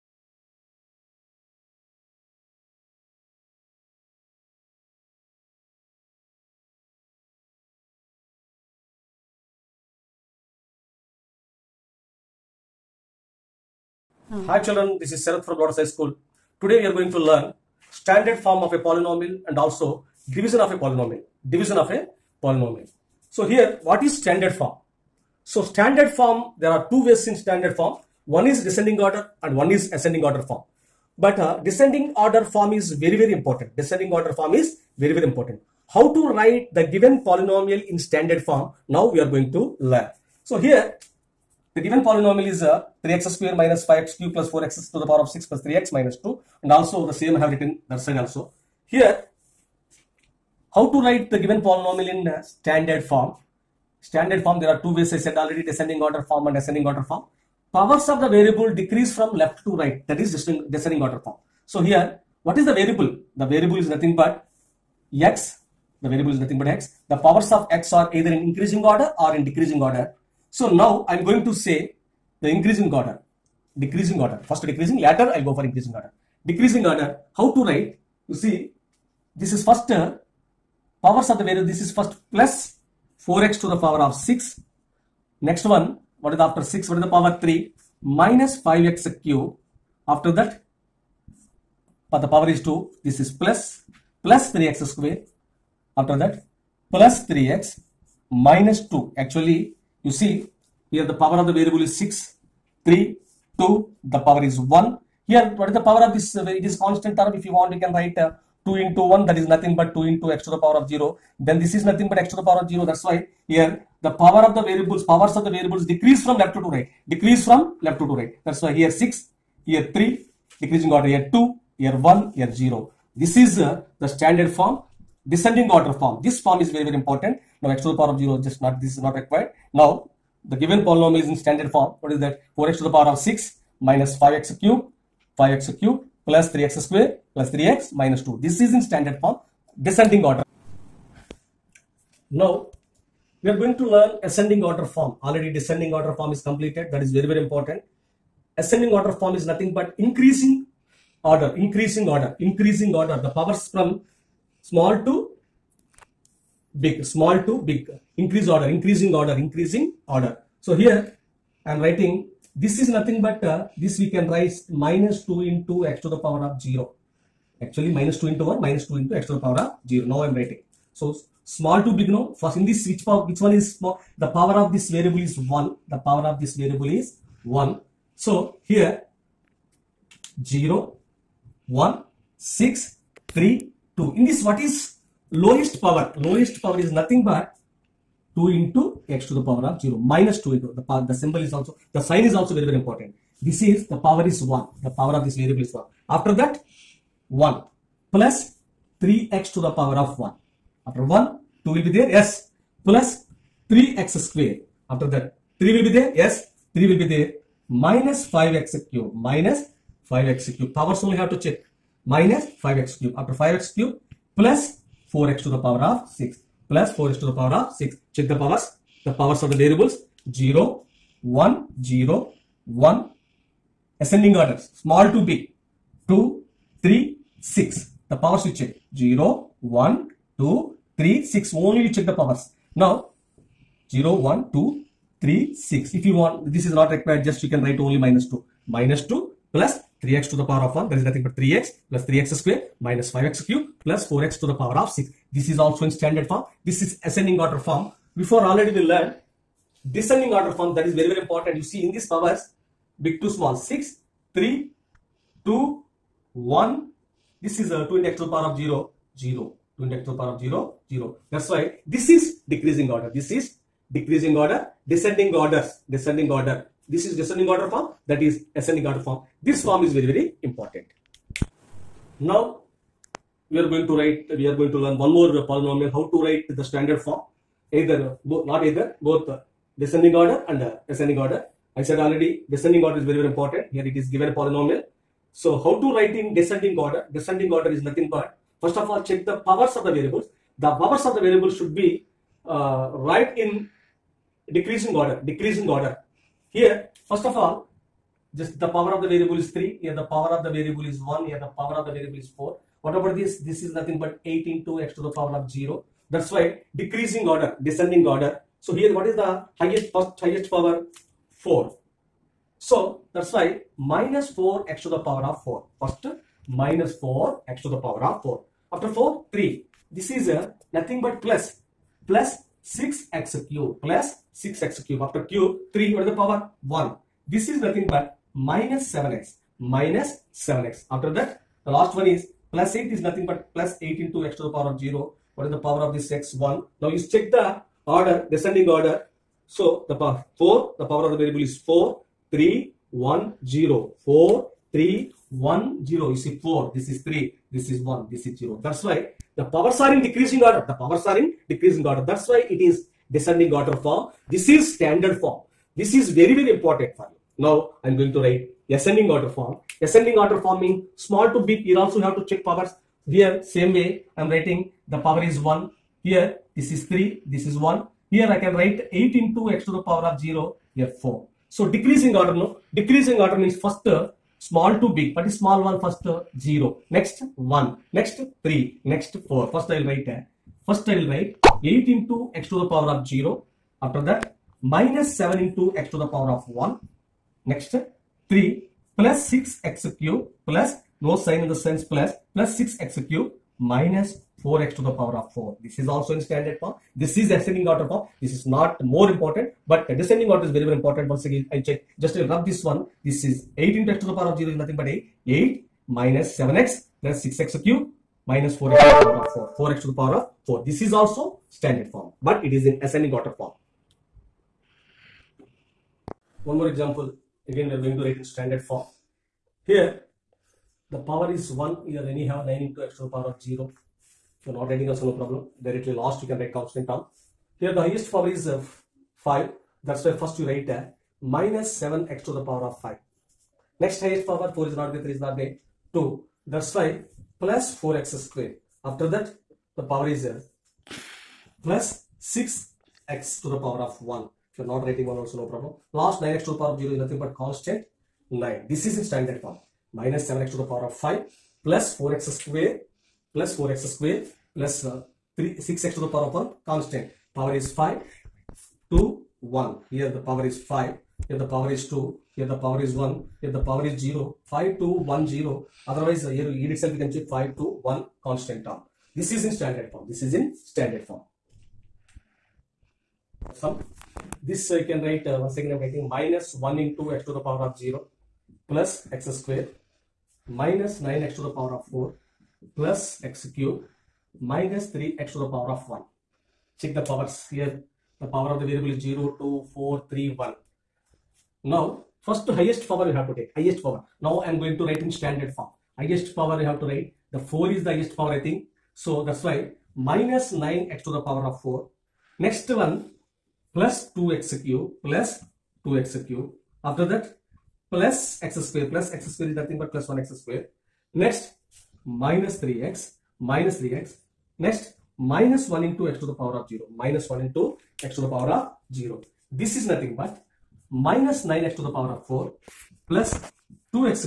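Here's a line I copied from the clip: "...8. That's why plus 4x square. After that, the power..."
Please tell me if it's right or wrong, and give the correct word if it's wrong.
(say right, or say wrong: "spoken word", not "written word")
wrong: "2", not "8".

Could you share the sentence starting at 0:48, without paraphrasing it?
Here, how to write the given polynomial in uh, standard form?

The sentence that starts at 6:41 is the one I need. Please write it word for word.
Once again, I check, just I rub this one.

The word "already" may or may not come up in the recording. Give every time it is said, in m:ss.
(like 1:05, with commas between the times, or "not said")
0:55, 2:25, 4:08, 4:41.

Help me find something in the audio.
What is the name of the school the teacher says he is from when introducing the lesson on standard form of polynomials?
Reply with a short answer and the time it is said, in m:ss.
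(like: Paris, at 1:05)
Lotus High School, at 0:15.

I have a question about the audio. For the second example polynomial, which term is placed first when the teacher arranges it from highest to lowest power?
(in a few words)
-4x^4.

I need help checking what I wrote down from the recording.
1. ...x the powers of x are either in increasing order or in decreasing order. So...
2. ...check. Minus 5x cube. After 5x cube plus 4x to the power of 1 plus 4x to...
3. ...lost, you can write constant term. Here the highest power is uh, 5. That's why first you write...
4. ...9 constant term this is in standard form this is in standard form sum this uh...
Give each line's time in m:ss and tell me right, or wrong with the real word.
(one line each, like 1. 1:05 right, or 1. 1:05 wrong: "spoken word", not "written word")
1. 1:06 right
2. 3:31 wrong: "6", not "1"
3. 7:05 right
4. 7:47 wrong: "1", not "9".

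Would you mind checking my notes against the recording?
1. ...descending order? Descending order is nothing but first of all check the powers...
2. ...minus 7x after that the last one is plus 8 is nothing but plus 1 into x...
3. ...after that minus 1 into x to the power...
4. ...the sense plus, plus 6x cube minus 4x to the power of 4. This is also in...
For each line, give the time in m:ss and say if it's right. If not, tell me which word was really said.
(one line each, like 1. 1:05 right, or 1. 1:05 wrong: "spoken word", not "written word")
1. 4:46 right
2. 5:29 wrong: "8", not "1"
3. 6:23 wrong: "7", not "1"
4. 6:31 right.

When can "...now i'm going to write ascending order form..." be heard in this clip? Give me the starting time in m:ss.
5:57.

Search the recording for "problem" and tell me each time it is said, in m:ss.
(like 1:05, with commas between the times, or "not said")
7:05, 7:25.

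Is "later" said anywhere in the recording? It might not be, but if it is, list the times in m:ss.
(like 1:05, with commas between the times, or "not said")
1:14.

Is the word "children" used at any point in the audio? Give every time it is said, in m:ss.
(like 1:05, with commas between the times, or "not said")
0:14.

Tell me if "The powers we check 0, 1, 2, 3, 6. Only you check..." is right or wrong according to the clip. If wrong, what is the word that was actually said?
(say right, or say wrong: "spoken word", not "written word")
right.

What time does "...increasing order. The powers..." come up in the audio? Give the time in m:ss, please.
2:32.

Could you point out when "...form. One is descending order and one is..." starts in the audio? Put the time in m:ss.
0:27.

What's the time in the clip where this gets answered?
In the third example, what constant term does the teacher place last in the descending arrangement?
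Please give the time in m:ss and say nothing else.
7:27.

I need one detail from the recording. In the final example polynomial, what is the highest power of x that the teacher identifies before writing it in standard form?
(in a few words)
4.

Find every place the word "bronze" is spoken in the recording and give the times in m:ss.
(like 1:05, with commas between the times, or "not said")
not said.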